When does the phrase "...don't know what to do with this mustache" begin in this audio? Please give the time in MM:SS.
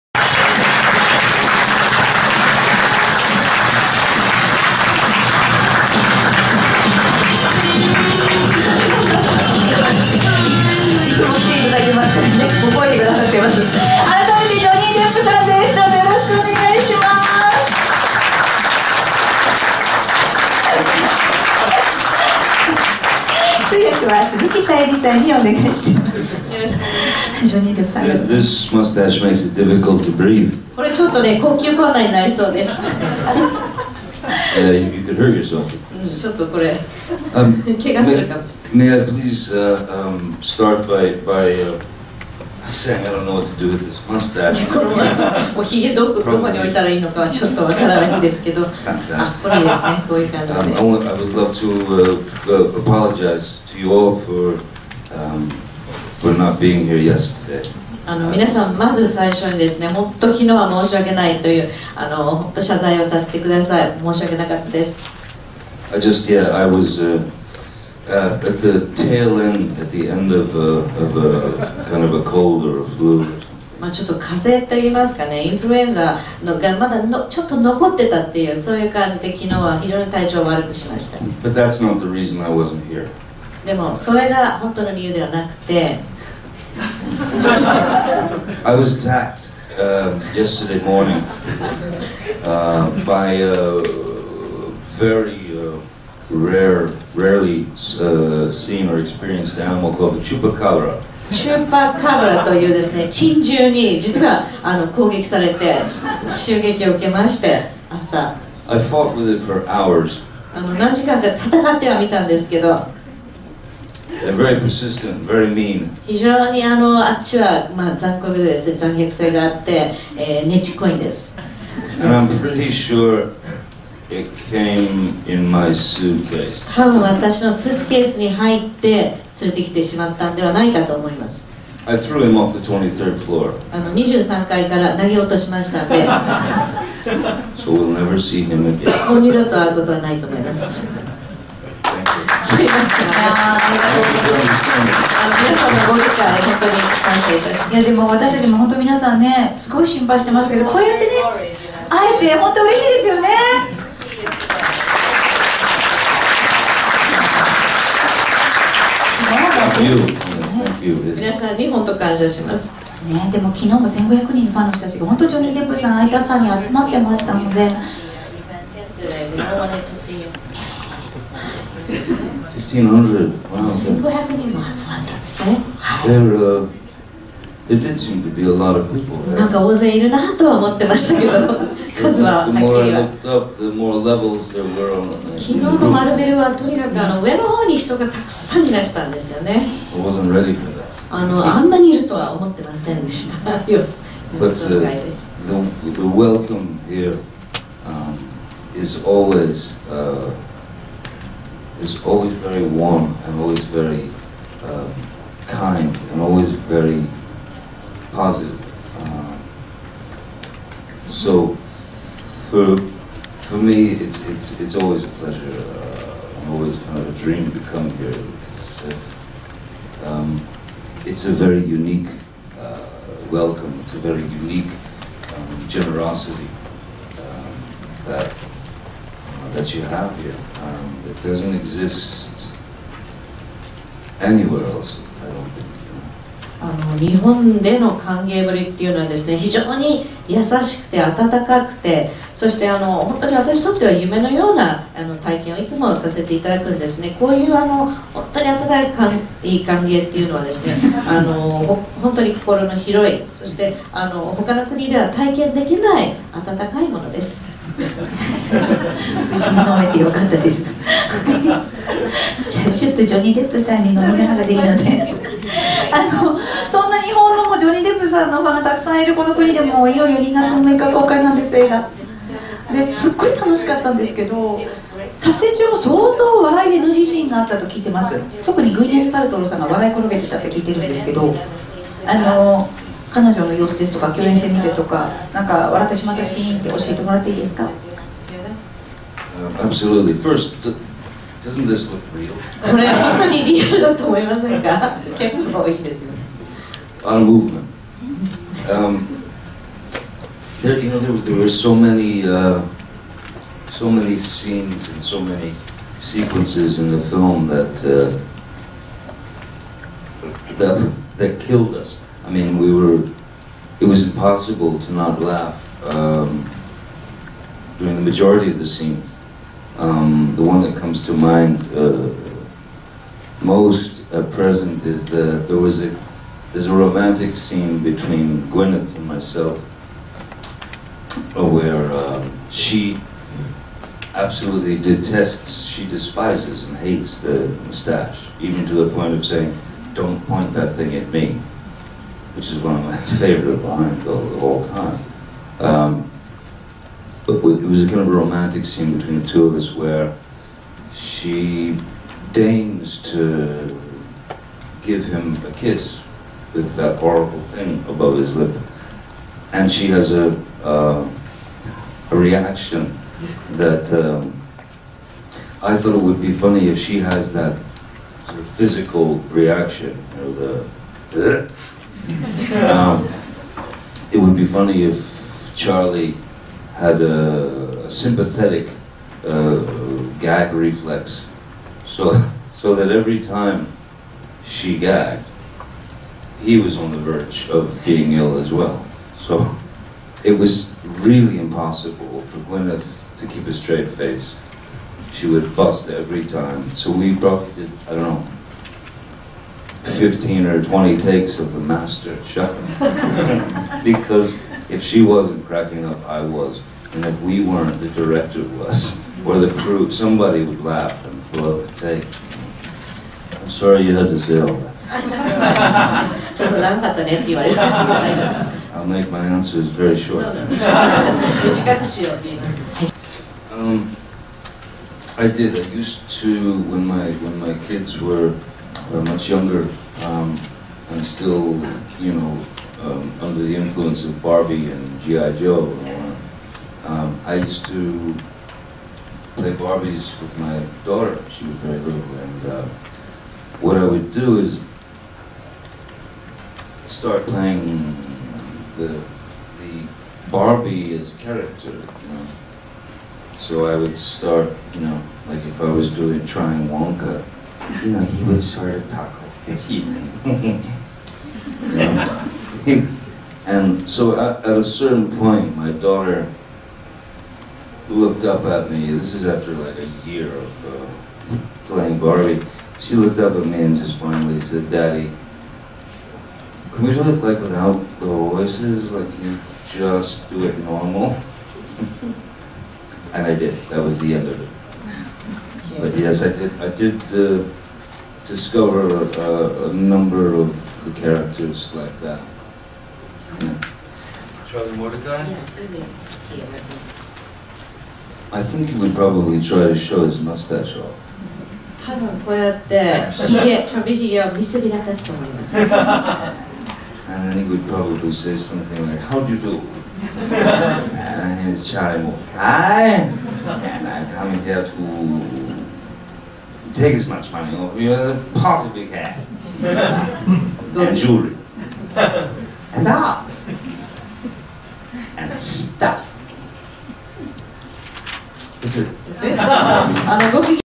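00:43.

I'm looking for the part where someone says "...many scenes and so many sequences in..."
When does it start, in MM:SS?
05:03.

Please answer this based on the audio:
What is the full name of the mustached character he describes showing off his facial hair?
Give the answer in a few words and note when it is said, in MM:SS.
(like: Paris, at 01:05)
Charlie Mordecai, at 08:14.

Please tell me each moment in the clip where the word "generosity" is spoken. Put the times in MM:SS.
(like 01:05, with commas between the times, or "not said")
03:45.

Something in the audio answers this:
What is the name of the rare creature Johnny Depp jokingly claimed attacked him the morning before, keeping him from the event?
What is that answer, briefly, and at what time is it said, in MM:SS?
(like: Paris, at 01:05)
chupacabra, at 01:40.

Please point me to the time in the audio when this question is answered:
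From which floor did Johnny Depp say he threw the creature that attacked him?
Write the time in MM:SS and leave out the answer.
02:12.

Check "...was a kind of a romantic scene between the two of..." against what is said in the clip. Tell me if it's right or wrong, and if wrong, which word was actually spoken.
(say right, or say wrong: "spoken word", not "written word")
right.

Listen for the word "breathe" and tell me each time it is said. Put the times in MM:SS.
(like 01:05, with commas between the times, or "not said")
00:30.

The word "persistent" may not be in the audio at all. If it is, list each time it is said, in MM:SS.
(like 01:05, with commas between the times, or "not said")
01:54.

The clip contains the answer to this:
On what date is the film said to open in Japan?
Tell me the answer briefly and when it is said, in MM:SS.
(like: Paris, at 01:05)
February 6, at 04:30.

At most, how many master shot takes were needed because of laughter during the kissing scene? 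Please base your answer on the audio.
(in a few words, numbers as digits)
20.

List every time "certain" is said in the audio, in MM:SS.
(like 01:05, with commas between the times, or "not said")
07:44.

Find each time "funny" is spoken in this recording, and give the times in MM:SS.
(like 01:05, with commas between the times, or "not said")
06:06, 06:14.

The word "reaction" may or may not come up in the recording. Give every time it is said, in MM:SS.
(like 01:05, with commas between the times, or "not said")
06:02, 06:09.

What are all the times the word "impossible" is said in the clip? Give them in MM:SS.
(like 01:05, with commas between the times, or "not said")
05:14, 06:31.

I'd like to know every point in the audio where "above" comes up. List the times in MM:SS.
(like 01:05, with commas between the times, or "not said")
05:57.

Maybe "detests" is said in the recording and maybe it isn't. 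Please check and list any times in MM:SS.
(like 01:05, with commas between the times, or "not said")
05:34.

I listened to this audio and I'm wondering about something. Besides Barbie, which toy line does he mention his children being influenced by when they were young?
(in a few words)
GI Joe.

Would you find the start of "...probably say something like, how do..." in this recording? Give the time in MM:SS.
08:27.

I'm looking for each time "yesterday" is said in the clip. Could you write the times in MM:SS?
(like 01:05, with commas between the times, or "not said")
00:57, 01:30.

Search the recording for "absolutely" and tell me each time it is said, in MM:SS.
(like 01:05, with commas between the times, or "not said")
04:49, 05:34.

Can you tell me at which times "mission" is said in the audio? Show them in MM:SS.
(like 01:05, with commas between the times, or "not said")
not said.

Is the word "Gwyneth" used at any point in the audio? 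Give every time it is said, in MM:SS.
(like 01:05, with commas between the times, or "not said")
05:28, 06:32.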